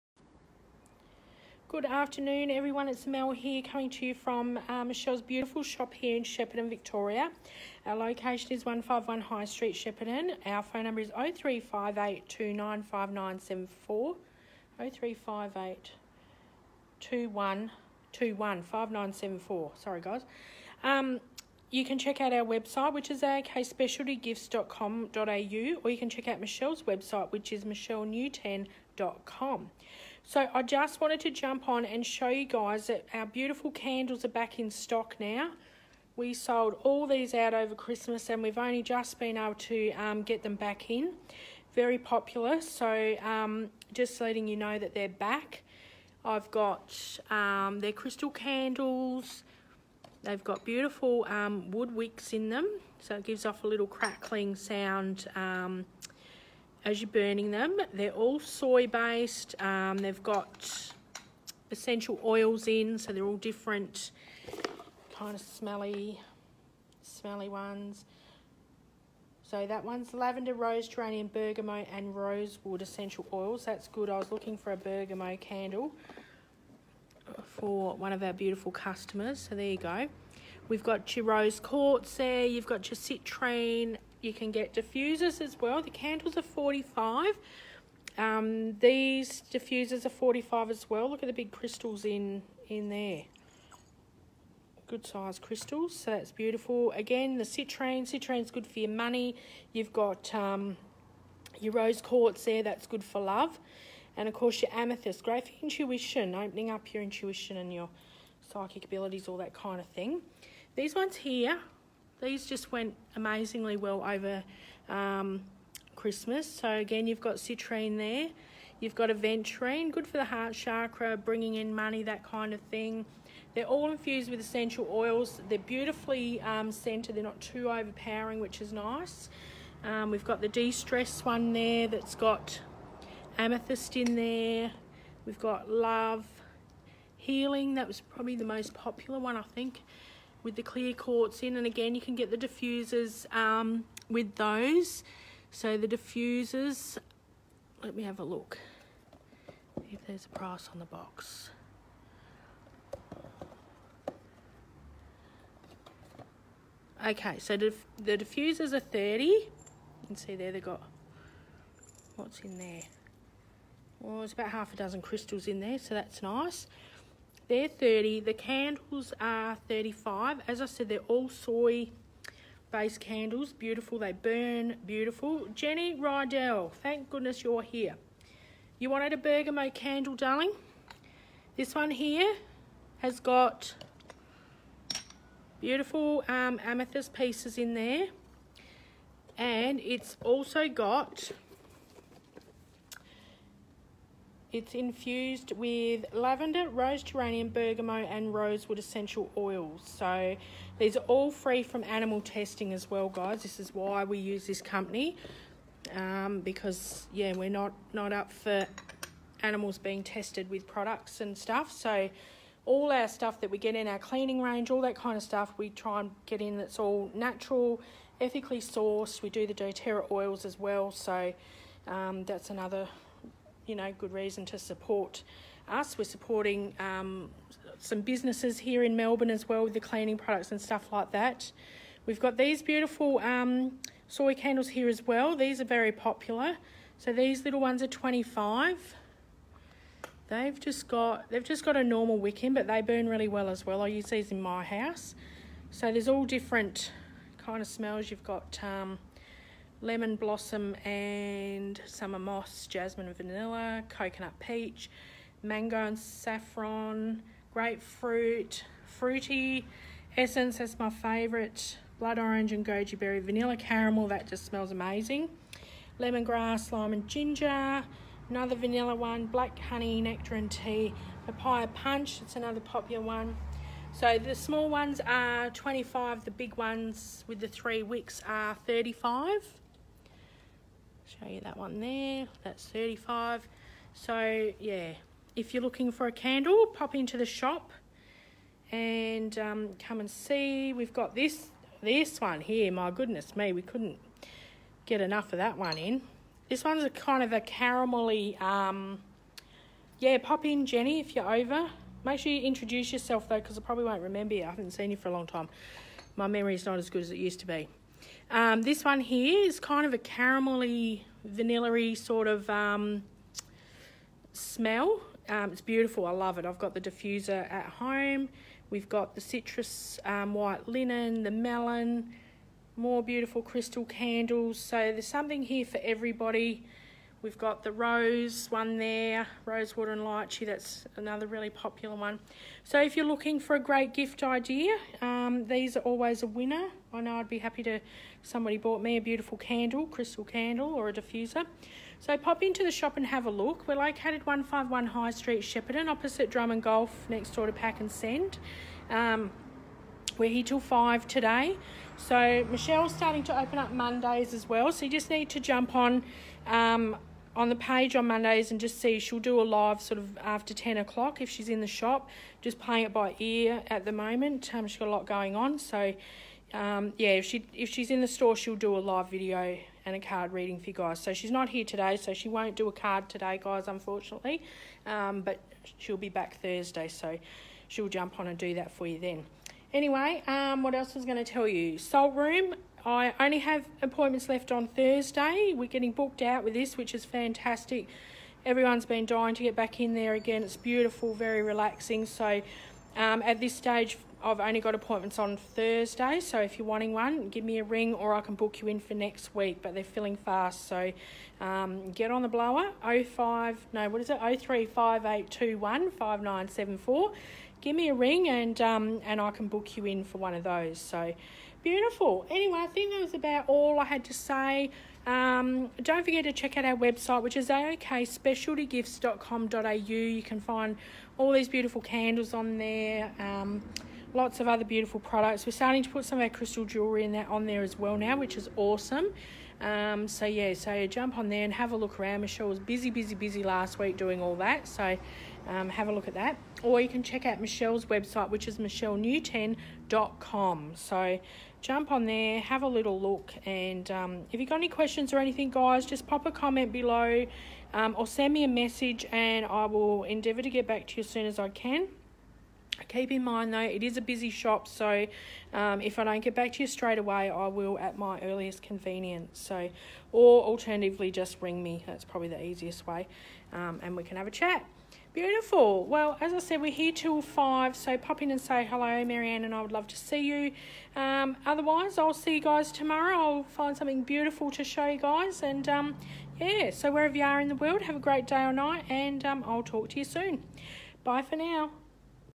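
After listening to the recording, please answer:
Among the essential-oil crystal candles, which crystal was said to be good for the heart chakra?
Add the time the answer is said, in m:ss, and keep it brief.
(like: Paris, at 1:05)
aventurine, at 1:59.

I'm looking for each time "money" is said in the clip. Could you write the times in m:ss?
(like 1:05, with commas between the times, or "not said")
1:38, 2:01.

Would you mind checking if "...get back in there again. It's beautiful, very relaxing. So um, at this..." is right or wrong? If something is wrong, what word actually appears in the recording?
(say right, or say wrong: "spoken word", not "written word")
right.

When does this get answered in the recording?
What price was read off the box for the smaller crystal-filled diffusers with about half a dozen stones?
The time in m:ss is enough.
2:38.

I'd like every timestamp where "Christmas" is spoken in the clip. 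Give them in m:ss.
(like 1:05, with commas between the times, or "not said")
0:37, 1:55.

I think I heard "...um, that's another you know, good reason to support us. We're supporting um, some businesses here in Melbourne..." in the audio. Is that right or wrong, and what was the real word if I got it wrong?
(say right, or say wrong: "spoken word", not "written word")
right.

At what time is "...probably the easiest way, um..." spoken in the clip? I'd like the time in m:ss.
7:42.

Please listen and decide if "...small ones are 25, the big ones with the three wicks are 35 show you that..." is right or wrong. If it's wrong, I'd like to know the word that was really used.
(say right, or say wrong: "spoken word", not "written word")
right.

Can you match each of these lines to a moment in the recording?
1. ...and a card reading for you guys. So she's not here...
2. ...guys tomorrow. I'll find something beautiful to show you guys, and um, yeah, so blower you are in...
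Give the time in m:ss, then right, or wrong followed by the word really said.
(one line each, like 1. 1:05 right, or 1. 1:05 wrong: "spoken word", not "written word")
1. 6:09 right
2. 7:52 wrong: "wherever", not "blower".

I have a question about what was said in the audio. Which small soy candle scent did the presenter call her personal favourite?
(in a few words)
grapefruit, fruity essence.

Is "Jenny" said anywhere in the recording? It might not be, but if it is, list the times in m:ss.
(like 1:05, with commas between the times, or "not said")
2:55, 5:00.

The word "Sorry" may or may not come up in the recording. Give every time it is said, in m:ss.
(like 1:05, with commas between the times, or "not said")
0:19.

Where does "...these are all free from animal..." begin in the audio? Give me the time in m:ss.
3:20.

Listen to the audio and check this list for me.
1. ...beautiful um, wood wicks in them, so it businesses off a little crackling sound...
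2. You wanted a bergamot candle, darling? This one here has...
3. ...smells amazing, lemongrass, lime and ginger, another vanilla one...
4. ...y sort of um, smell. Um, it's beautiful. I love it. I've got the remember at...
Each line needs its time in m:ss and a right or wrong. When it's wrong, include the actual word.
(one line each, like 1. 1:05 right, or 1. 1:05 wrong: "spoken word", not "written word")
1. 0:50 wrong: "gives", not "businesses"
2. 2:58 right
3. 4:24 right
4. 5:11 wrong: "diffuser", not "remember".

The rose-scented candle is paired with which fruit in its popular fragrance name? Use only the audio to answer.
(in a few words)
lychee.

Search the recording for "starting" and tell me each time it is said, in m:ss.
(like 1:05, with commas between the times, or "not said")
5:52, 7:05.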